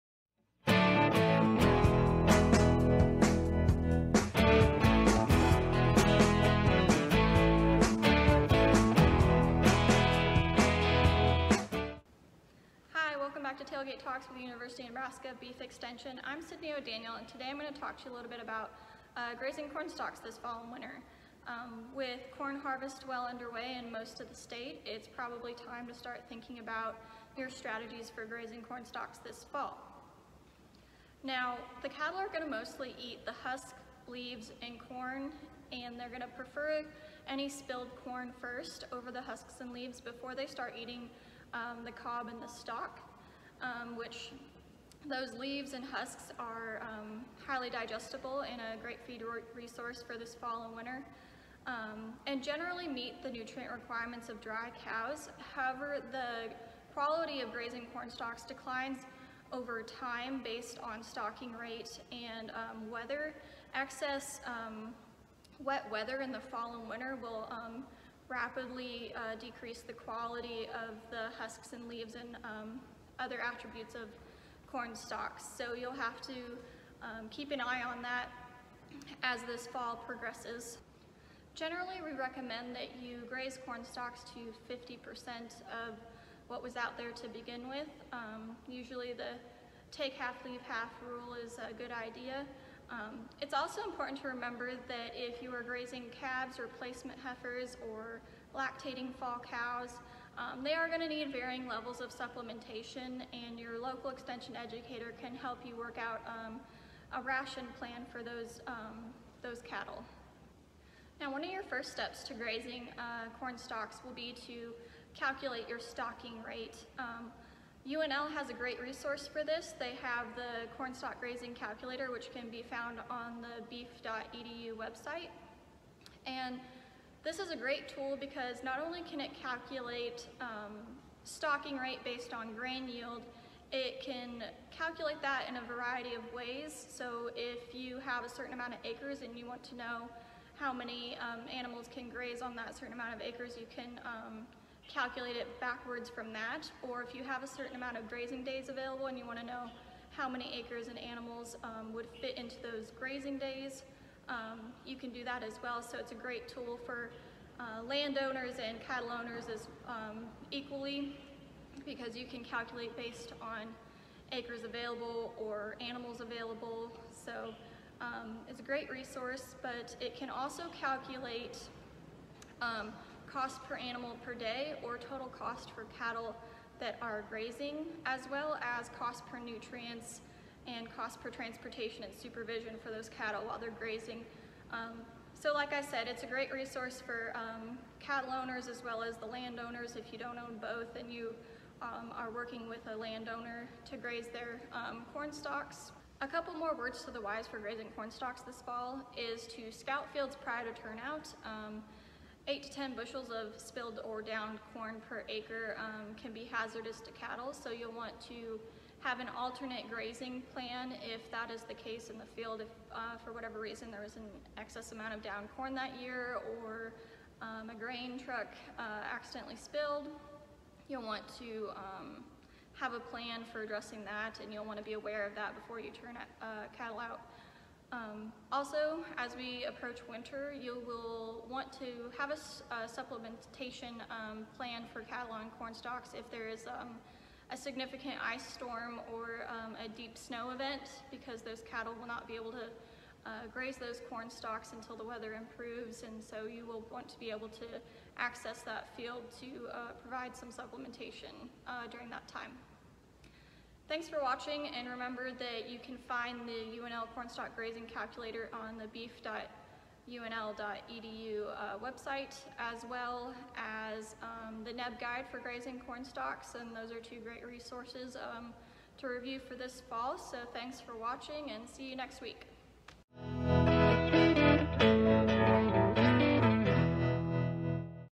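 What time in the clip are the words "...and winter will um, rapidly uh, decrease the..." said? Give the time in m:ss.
1:06.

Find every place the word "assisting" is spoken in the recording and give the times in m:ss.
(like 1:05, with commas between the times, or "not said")
not said.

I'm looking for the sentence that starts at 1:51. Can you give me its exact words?
Now one of your first steps to grazing uh, corn stalks will be to calculate your stocking rate.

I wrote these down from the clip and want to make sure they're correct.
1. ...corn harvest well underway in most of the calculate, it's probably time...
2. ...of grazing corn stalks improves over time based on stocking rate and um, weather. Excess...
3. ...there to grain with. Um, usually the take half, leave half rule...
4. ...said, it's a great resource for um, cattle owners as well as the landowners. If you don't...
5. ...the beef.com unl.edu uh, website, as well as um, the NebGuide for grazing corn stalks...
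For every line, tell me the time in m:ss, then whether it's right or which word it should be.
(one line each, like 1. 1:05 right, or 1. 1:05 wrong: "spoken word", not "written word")
1. 0:22 wrong: "state", not "calculate"
2. 0:57 wrong: "declines", not "improves"
3. 1:26 wrong: "begin", not "grain"
4. 3:05 right
5. 4:18 right.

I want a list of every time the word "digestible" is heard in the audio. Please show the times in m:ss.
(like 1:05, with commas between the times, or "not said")
0:47.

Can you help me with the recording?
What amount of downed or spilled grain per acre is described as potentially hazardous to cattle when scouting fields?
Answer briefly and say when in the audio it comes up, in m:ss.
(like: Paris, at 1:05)
8 to 10 bushels, at 3:22.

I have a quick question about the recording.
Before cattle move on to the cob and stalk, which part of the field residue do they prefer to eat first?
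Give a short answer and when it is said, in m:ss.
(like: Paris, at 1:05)
Spilled corn, at 0:37.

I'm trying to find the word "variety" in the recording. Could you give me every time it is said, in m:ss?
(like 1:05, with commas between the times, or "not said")
2:15.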